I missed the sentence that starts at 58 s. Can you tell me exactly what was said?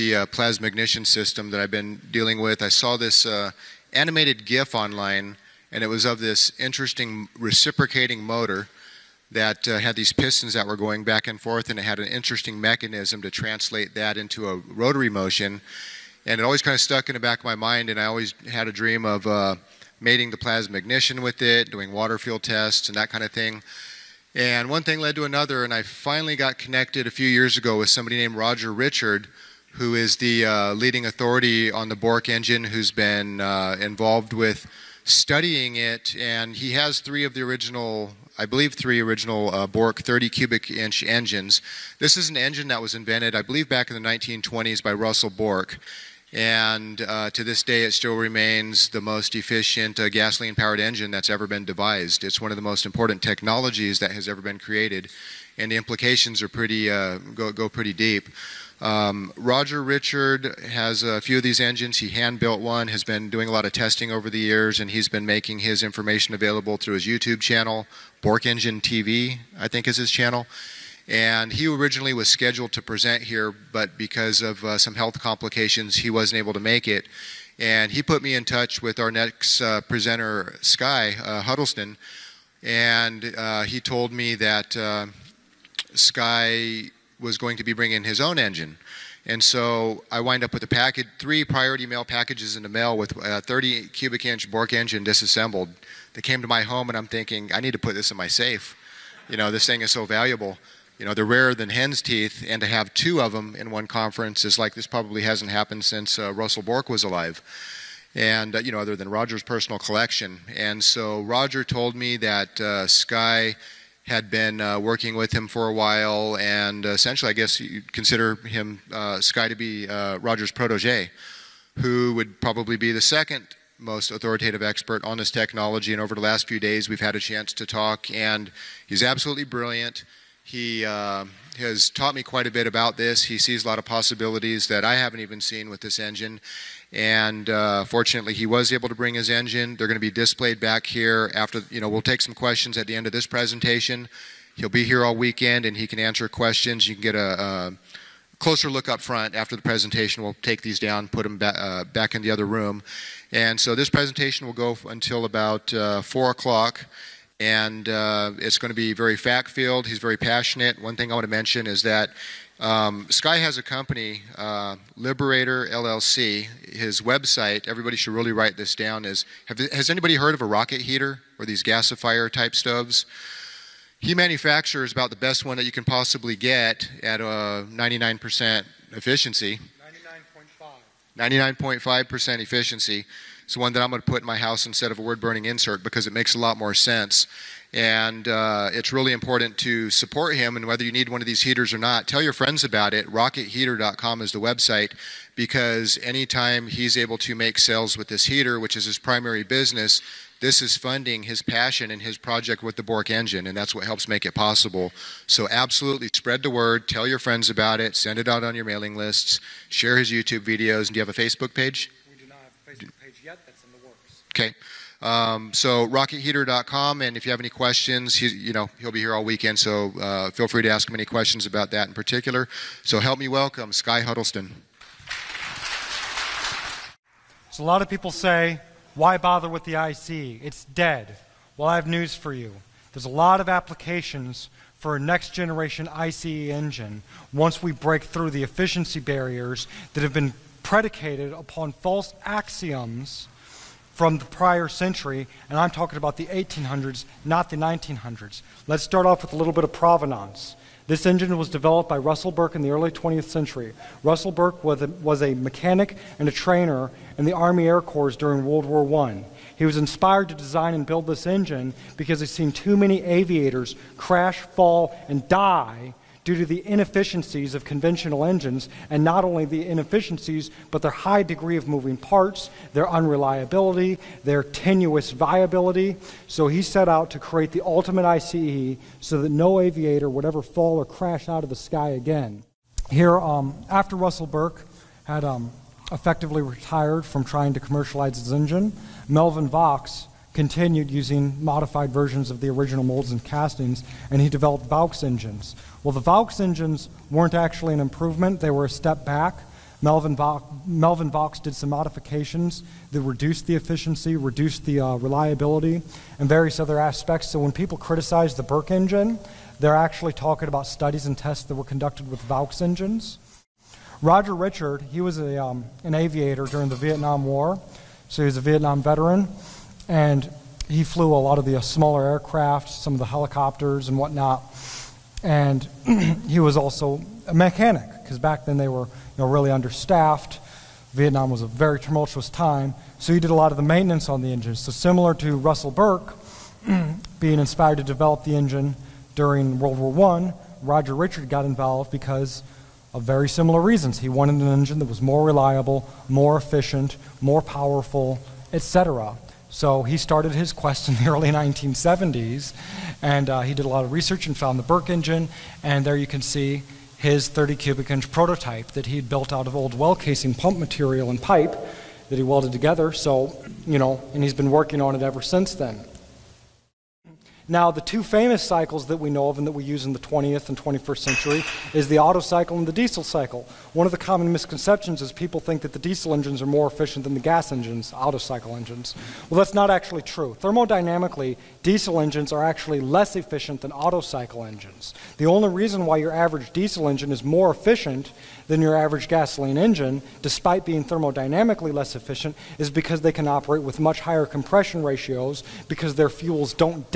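Um, Roger Richard has a few of these engines.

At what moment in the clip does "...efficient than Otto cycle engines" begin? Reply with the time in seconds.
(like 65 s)
383 s.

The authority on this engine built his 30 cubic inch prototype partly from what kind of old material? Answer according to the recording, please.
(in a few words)
well casing pump material.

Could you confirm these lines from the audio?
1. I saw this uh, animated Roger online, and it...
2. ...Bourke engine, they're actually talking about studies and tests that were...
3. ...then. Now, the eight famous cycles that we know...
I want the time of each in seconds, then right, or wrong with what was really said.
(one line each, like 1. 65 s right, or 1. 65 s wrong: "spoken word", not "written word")
1. 2 s wrong: "GIF", not "Roger"
2. 308 s right
3. 365 s wrong: "two", not "eight".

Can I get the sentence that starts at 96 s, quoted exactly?
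They came to my home, and I'm thinking, I need to put this in my safe.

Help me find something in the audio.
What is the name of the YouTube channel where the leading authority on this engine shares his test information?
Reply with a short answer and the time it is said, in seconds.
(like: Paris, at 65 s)
Bourke Engine TV, at 68 s.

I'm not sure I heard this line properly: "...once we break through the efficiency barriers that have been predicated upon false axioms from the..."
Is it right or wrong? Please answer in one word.
right.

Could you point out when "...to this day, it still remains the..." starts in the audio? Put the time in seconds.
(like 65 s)
47 s.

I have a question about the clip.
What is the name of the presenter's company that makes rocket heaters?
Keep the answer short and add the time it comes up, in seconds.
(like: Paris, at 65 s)
Liberator LLC, at 164 s.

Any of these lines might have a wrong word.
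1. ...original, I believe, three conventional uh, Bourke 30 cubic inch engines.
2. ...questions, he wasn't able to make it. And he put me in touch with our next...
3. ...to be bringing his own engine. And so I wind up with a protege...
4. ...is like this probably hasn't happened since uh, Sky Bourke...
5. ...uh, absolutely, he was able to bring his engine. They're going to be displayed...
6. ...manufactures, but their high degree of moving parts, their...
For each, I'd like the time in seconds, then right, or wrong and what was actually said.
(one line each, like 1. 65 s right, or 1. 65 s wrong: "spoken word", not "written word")
1. 37 s wrong: "original", not "conventional"
2. 75 s wrong: "complications", not "questions"
3. 87 s wrong: "package", not "protege"
4. 104 s wrong: "Russell", not "Sky"
5. 137 s wrong: "fortunately", not "absolutely"
6. 269 s wrong: "inefficiencies", not "manufactures".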